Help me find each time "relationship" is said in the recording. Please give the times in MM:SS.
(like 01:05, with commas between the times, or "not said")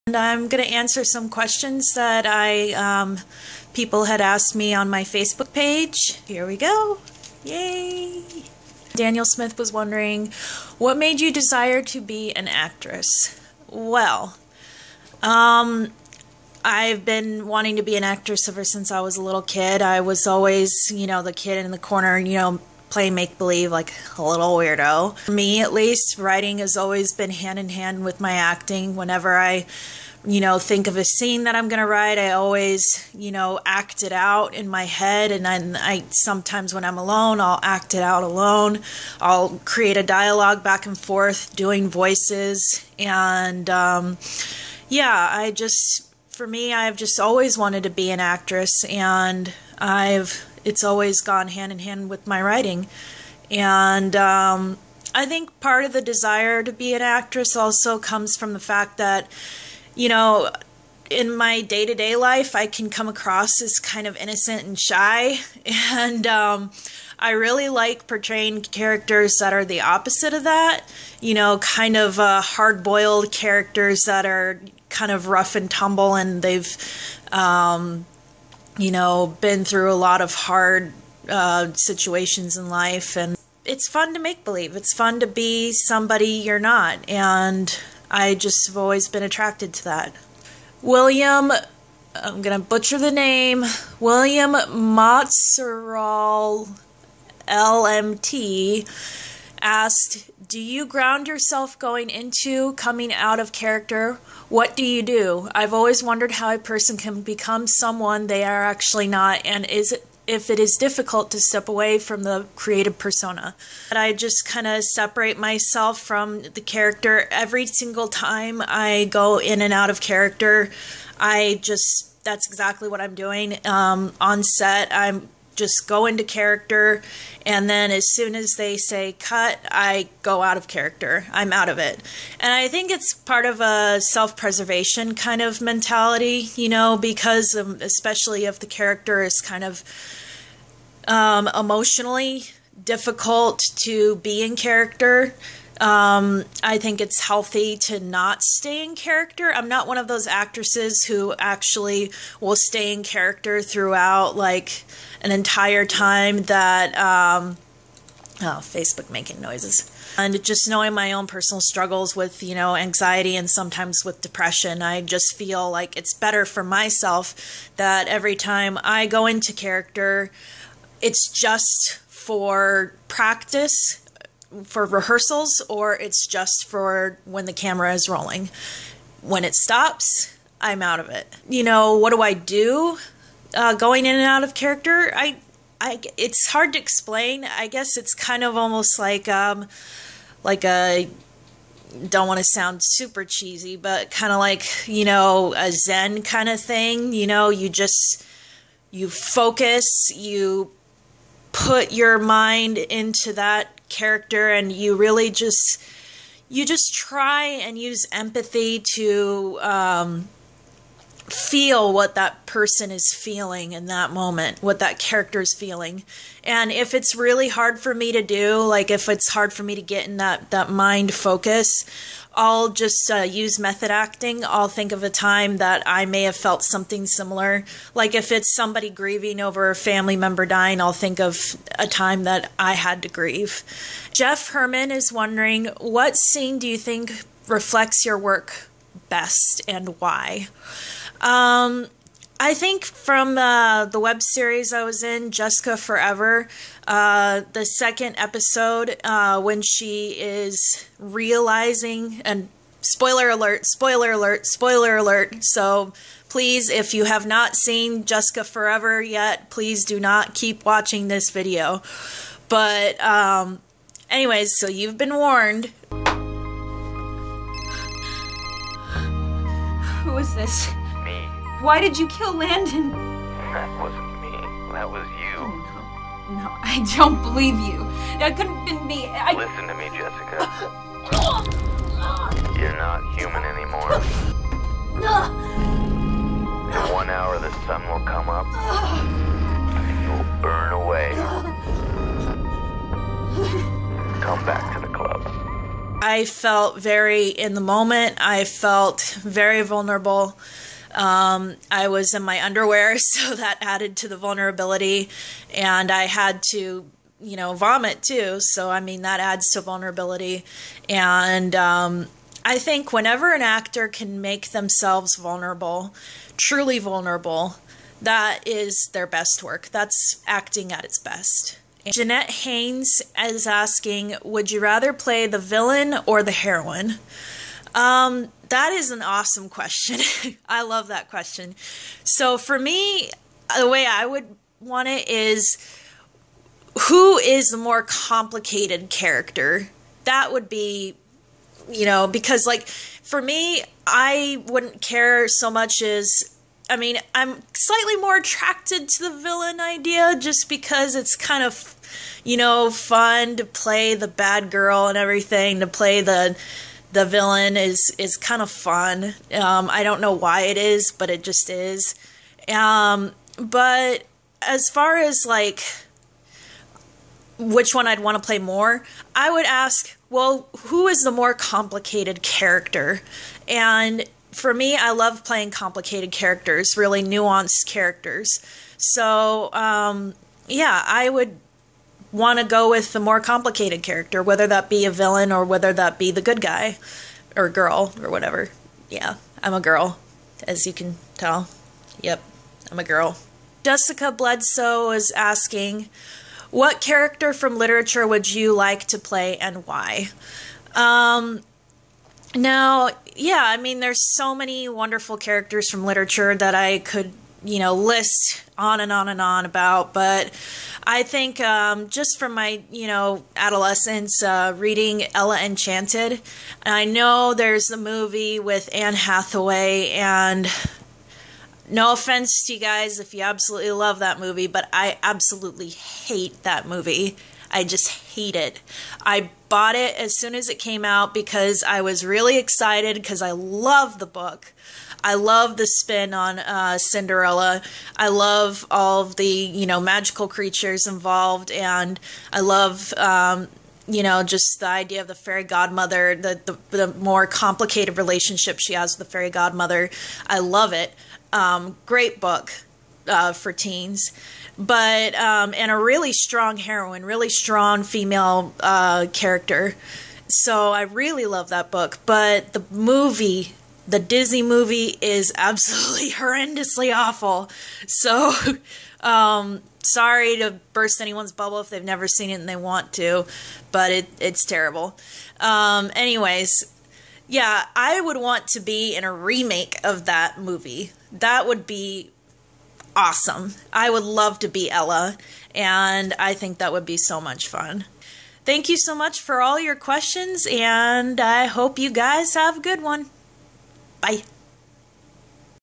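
07:27.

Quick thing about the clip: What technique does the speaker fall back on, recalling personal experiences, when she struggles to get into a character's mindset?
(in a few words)
method acting.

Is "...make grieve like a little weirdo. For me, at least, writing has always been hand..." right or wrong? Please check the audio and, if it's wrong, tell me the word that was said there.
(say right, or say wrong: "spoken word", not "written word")
wrong: "believe", not "grieve".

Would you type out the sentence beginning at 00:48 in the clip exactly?
And I've, it's always gone hand in hand with my writing.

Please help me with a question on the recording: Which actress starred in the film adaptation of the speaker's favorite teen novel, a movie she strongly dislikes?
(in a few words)
Anne Hathaway.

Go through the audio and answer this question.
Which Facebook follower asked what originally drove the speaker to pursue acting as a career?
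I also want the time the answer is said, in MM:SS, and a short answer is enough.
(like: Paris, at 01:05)
Daniel Smith, at 00:08.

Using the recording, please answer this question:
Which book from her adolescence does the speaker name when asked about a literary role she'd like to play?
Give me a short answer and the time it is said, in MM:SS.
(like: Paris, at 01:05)
Ella Enchanted, at 06:55.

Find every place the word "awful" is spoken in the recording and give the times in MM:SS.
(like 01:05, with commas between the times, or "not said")
07:46.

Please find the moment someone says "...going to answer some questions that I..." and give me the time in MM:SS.
00:00.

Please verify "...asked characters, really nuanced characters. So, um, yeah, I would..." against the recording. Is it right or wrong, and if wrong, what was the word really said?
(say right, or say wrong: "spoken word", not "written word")
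wrong: "complicated", not "asked".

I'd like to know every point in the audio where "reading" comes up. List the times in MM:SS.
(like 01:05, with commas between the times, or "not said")
06:54.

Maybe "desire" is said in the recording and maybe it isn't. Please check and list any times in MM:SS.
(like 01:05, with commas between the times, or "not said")
00:11, 00:56.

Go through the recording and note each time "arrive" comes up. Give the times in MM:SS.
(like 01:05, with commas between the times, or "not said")
not said.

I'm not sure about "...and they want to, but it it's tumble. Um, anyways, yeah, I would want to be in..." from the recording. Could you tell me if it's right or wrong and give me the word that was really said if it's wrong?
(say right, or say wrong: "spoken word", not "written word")
wrong: "terrible", not "tumble".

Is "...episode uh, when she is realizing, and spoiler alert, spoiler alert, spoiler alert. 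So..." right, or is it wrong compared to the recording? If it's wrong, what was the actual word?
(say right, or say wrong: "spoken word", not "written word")
right.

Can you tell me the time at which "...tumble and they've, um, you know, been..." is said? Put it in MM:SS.
01:15.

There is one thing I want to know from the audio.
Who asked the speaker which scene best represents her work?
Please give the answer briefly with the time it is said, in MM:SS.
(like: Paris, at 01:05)
Jeff Herman, at 03:54.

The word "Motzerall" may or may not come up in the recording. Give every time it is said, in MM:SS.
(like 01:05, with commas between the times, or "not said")
01:34.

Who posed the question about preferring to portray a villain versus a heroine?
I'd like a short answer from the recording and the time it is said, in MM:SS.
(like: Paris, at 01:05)
Jeanette Haynes, at 05:21.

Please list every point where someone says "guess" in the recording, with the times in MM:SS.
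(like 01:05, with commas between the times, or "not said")
03:07.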